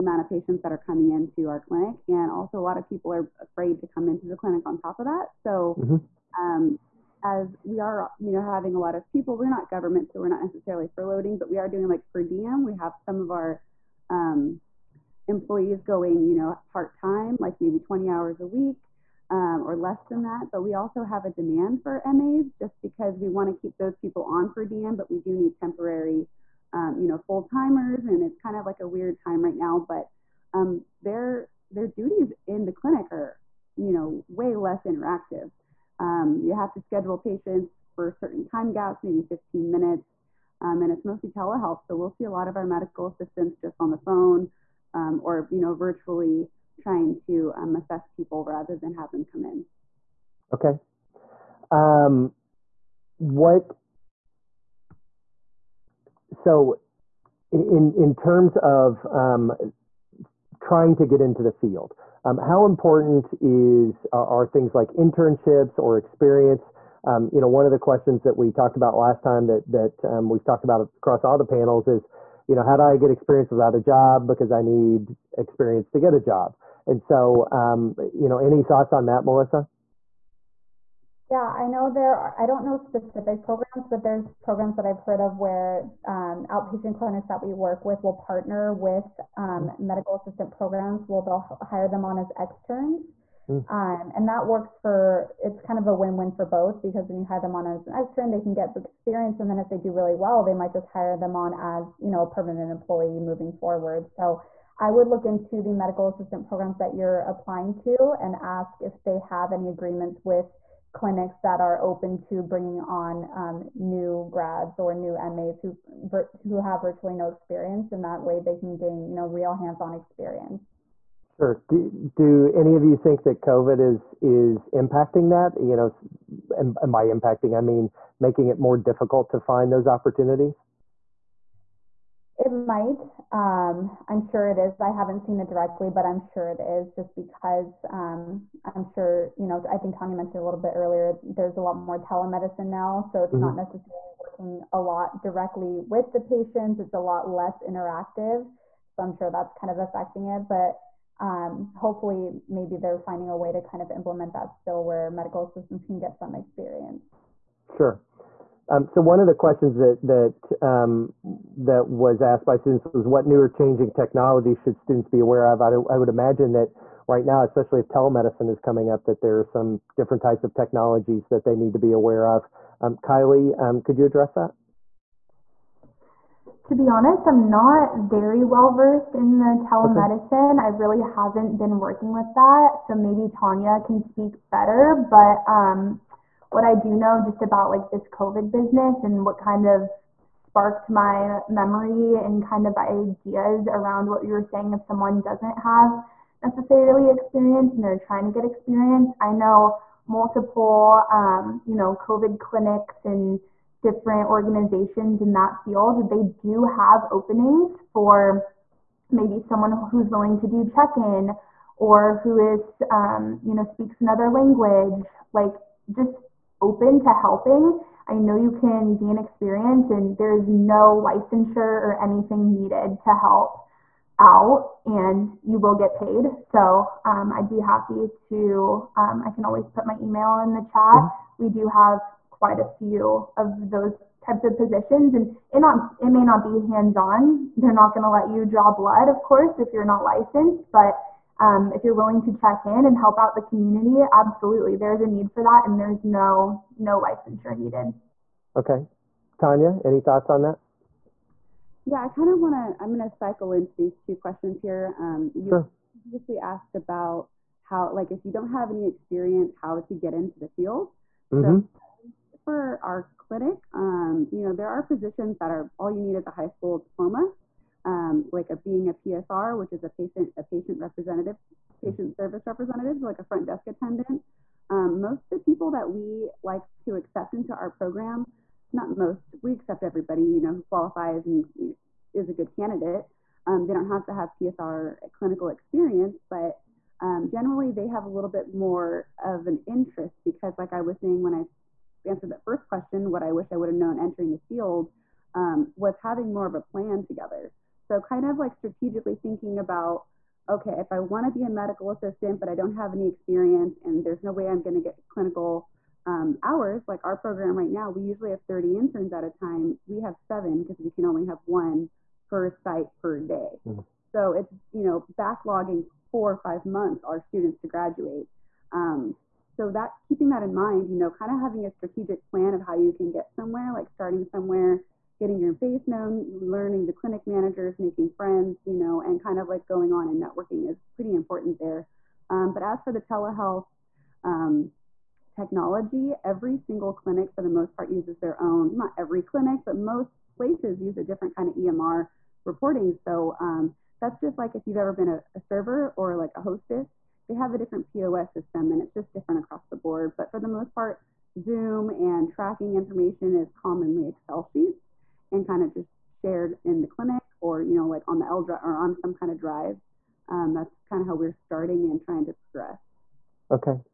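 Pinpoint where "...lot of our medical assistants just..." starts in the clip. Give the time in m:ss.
0:42.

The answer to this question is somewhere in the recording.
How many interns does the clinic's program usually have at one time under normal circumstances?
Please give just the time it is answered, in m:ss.
5:08.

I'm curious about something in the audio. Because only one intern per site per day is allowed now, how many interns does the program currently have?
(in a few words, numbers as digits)
7.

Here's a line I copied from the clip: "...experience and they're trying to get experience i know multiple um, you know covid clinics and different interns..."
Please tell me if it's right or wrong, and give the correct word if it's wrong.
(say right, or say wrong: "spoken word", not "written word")
wrong: "organizations", not "interns".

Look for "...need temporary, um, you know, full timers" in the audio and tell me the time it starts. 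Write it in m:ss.
0:25.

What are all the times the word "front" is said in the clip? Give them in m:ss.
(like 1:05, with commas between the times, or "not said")
4:33.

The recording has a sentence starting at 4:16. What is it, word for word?
previously asked about how like if you don't have any experience how to get into the field mm-hmm.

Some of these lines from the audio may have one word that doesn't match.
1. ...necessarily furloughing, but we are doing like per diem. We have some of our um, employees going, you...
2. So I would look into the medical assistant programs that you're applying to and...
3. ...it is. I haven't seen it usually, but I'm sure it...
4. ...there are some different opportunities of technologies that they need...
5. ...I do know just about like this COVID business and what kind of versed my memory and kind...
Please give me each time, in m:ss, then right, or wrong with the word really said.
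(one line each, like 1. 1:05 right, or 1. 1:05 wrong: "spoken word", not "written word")
1. 0:10 right
2. 1:44 right
3. 2:14 wrong: "directly", not "usually"
4. 2:49 wrong: "types", not "opportunities"
5. 3:06 wrong: "sparked", not "versed".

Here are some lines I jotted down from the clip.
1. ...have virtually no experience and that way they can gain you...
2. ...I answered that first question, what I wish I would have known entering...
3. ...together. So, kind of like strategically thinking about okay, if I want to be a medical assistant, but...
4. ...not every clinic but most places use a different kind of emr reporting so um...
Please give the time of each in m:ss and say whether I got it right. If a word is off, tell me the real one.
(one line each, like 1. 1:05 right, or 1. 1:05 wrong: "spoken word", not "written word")
1. 1:56 right
2. 4:51 right
3. 4:57 right
4. 5:38 right.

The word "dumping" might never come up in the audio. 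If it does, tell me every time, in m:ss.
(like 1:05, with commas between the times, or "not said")
not said.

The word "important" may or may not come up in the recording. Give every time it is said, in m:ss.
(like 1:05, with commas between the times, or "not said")
1:02, 5:31.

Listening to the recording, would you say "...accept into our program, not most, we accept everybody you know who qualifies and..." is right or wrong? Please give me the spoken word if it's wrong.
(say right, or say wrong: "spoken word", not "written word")
right.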